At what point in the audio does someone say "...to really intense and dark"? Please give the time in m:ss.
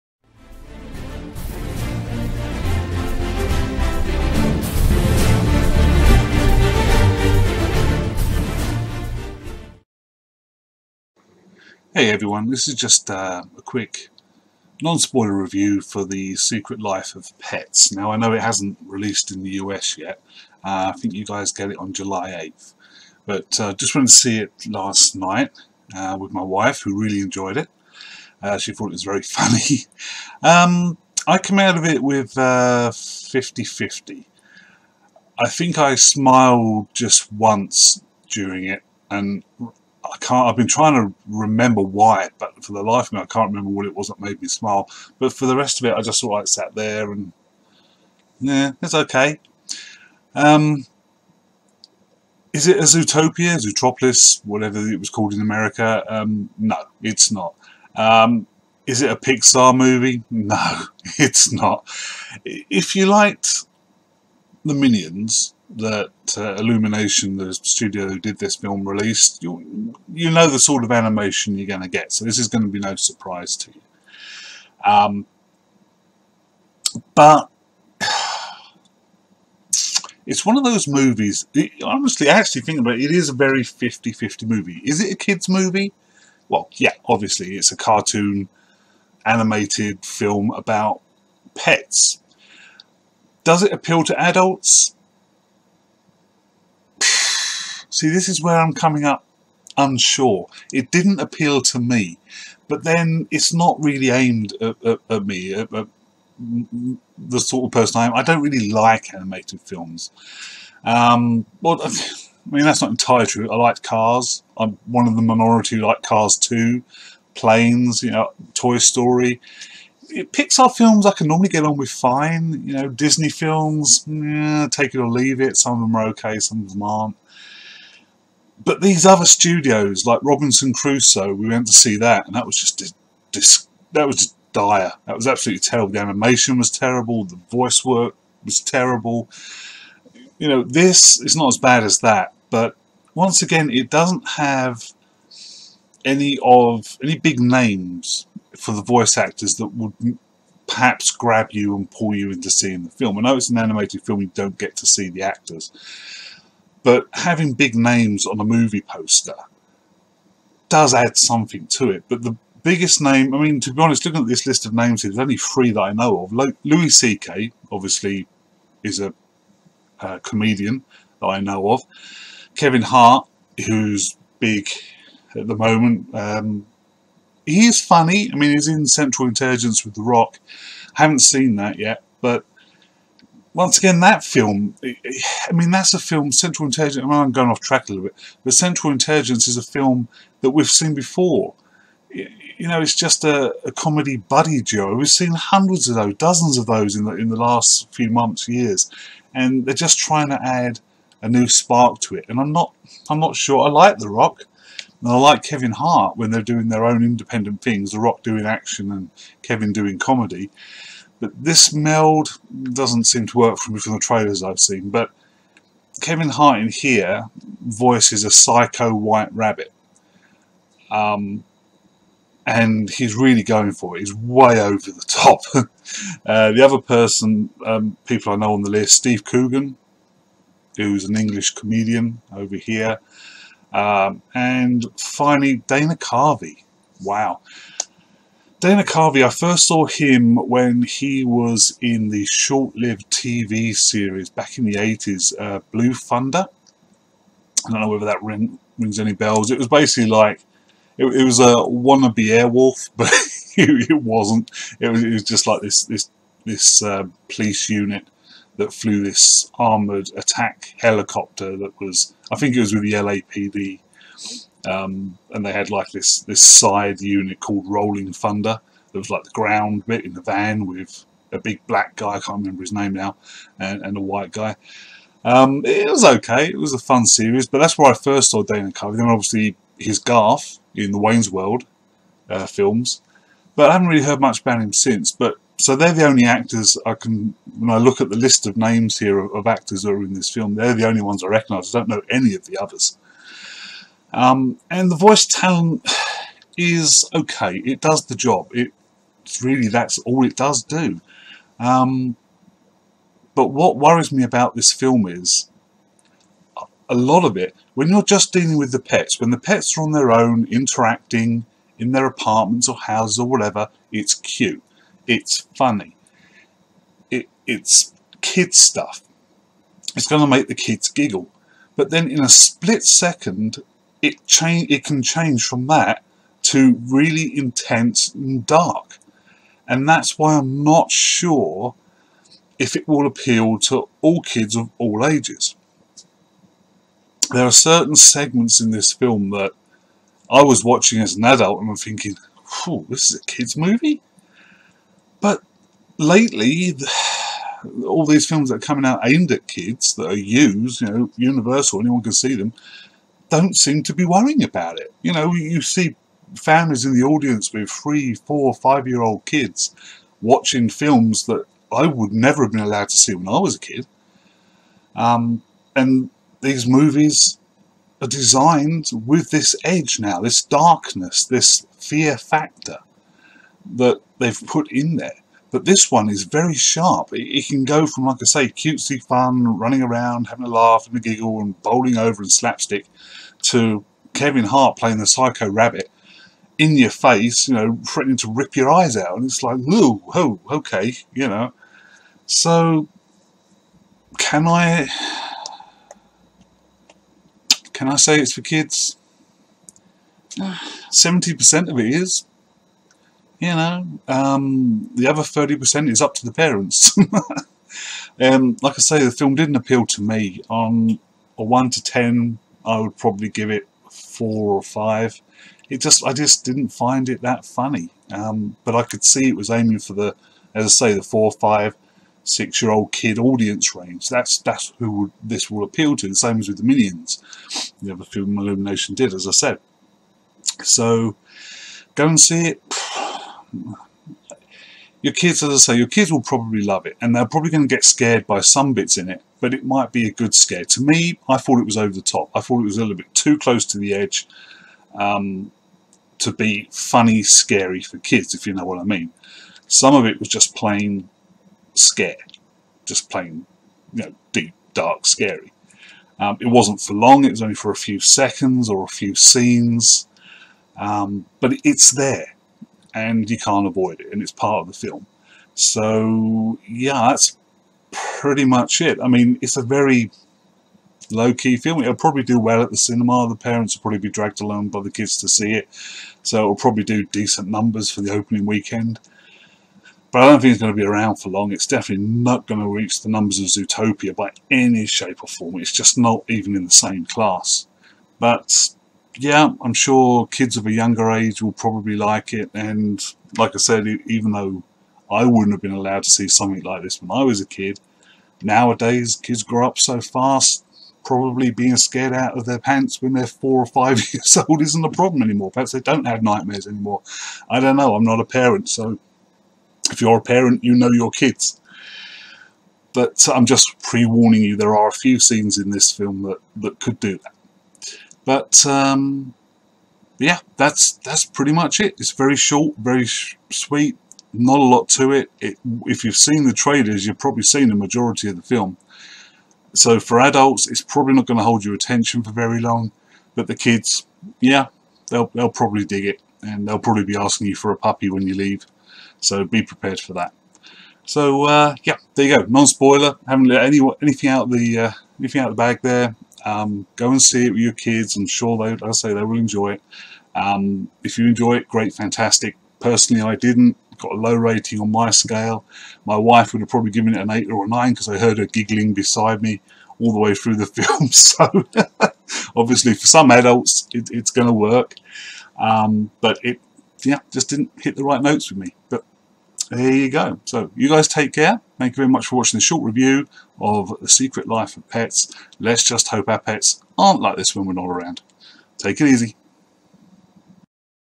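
5:26.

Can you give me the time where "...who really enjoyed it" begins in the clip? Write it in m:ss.
0:26.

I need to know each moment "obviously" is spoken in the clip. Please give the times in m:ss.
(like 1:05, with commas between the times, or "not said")
1:27, 2:47, 4:39, 9:22.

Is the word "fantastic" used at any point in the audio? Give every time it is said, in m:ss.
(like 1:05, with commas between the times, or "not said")
9:11.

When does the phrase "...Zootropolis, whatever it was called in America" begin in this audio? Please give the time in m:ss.
0:53.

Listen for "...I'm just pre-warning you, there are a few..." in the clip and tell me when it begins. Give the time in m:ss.
8:33.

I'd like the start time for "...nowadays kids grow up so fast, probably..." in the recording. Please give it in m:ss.
8:18.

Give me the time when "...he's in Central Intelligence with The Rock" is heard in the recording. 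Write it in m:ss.
2:58.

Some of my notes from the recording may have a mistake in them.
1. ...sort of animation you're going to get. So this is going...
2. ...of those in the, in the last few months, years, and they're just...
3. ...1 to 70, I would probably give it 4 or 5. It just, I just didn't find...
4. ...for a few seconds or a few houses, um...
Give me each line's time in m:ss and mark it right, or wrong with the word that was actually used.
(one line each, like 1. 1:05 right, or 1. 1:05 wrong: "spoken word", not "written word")
1. 1:10 right
2. 3:16 right
3. 6:51 wrong: "10", not "70"
4. 7:37 wrong: "scenes", not "houses".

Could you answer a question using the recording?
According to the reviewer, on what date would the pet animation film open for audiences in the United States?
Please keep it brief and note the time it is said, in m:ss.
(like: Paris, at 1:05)
July 8th, at 0:21.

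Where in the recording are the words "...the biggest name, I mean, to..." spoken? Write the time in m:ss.
2:42.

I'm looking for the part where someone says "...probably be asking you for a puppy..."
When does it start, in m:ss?
8:56.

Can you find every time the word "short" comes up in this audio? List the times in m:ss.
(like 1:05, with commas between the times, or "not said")
4:02, 8:42, 9:32.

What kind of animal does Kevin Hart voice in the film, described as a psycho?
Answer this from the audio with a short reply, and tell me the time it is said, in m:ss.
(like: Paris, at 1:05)
White rabbit, at 3:38.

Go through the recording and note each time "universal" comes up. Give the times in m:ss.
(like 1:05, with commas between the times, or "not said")
5:51.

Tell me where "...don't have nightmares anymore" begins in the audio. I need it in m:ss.
8:25.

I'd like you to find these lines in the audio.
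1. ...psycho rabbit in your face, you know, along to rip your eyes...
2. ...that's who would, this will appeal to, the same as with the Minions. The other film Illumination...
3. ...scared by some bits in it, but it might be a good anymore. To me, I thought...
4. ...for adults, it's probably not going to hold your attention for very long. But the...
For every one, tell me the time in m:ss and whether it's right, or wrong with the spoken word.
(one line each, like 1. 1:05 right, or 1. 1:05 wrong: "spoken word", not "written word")
1. 6:25 wrong: "threatening", not "along"
2. 7:04 right
3. 7:17 wrong: "scare", not "anymore"
4. 8:49 right.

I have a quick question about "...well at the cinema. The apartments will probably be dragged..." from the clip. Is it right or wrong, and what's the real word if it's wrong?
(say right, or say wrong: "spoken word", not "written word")
wrong: "parents", not "apartments".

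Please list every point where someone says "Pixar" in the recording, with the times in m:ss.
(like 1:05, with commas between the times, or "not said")
0:59, 2:00.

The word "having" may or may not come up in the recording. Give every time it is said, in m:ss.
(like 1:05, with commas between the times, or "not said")
2:37, 6:20.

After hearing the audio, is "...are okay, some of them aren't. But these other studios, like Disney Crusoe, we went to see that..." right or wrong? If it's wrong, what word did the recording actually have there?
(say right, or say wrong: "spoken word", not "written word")
wrong: "Robinson", not "Disney".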